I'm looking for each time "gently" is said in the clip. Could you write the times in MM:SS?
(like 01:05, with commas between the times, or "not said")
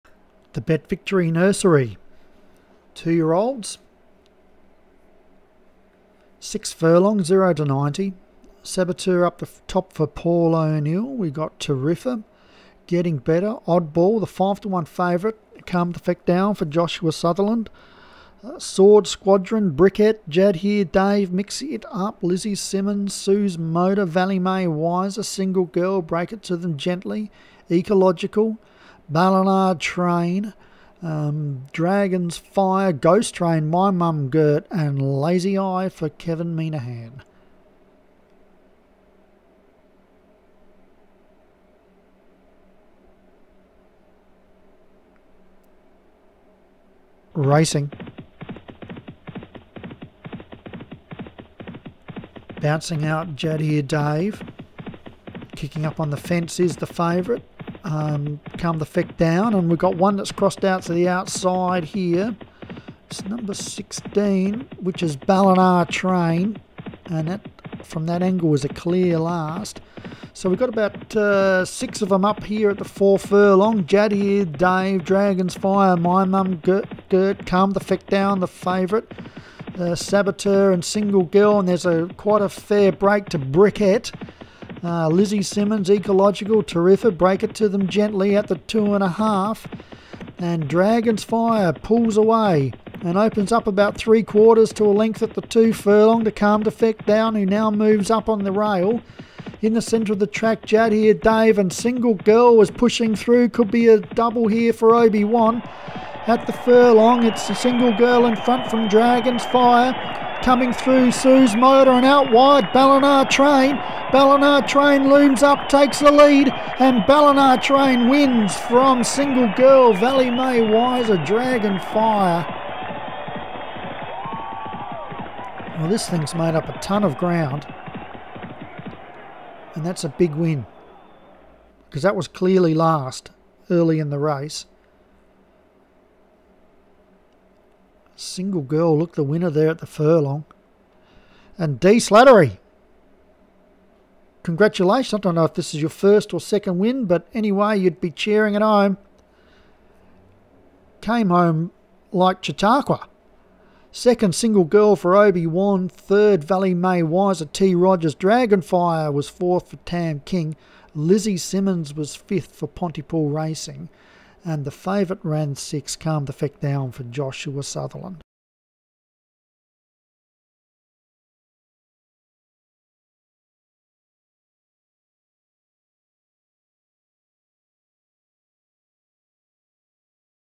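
00:26, 01:27.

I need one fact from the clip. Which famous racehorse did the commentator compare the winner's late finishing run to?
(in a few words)
Chautauqua.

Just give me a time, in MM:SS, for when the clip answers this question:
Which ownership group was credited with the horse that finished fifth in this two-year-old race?
02:42.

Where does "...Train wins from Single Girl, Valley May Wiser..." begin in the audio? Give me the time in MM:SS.
01:57.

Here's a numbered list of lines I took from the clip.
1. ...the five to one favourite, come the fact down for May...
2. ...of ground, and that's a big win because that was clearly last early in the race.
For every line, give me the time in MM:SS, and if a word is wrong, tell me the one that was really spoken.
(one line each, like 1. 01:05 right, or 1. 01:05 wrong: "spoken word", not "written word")
1. 00:14 wrong: "Joshua", not "May"
2. 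02:07 right.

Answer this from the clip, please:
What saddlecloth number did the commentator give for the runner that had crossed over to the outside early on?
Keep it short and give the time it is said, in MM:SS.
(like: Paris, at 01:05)
16, at 01:03.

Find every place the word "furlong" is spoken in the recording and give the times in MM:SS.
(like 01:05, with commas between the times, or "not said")
00:06, 01:13, 01:35, 01:46, 02:19.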